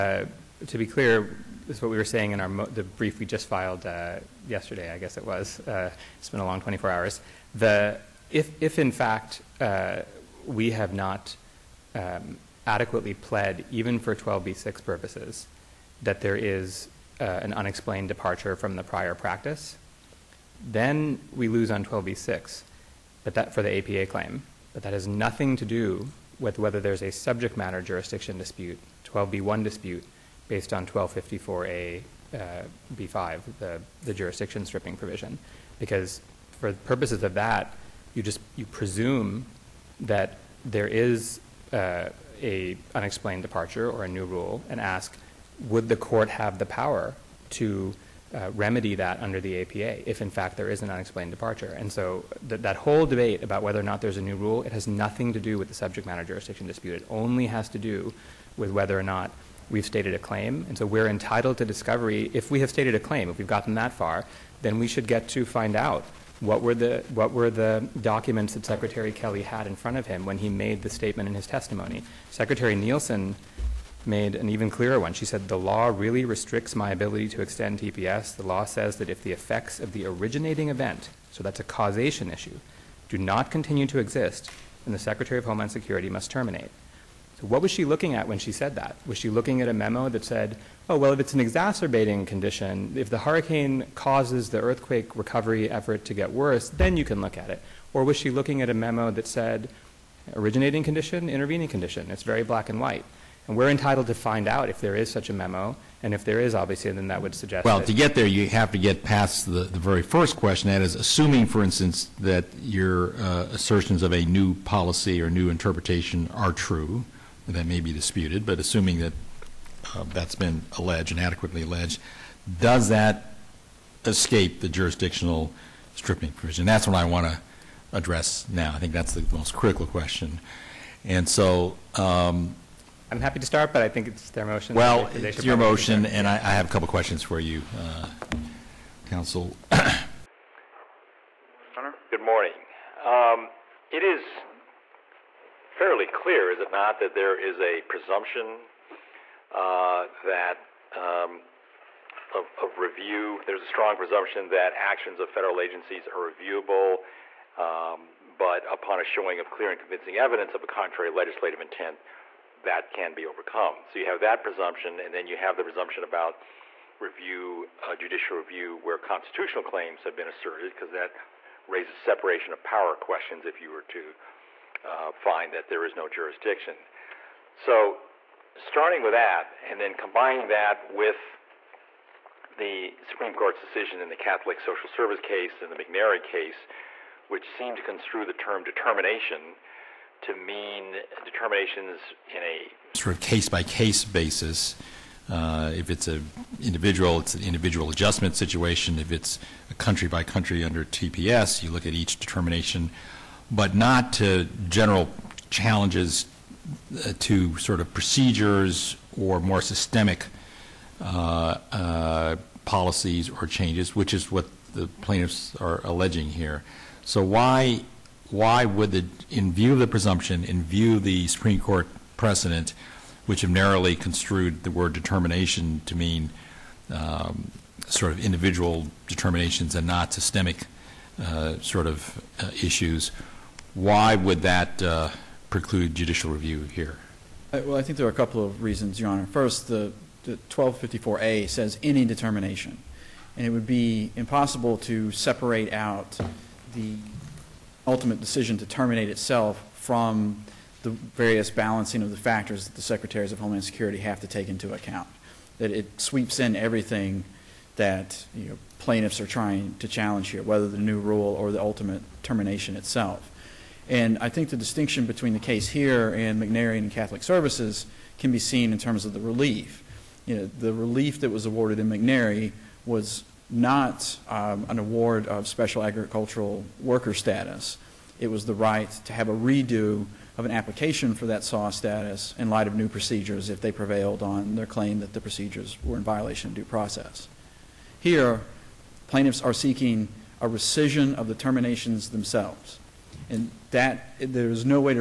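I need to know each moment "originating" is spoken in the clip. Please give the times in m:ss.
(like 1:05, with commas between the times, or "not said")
1:20, 1:40.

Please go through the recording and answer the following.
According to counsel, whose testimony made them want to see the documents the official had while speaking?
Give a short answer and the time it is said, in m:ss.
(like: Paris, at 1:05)
Secretary Kelly, at 1:08.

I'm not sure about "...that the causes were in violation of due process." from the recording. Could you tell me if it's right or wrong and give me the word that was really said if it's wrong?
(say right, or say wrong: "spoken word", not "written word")
wrong: "procedures", not "causes".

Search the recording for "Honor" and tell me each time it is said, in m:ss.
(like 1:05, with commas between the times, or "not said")
3:59.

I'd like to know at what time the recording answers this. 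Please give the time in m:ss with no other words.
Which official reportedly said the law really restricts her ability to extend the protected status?
1:12.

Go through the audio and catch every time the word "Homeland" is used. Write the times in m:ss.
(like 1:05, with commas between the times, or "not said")
1:25, 4:13.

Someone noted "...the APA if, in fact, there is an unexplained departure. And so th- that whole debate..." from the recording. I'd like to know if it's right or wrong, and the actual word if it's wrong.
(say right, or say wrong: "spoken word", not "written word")
right.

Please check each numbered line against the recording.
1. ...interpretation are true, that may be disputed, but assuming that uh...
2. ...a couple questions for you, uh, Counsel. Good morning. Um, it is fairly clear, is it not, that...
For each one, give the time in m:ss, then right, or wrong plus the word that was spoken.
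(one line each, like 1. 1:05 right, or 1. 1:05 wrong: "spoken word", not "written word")
1. 1:55 right
2. 2:16 right.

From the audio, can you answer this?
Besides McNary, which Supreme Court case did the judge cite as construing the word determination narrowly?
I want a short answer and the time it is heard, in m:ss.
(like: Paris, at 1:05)
Catholic Social Service, at 3:04.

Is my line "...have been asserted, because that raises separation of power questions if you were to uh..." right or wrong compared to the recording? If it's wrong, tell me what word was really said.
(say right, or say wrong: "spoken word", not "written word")
right.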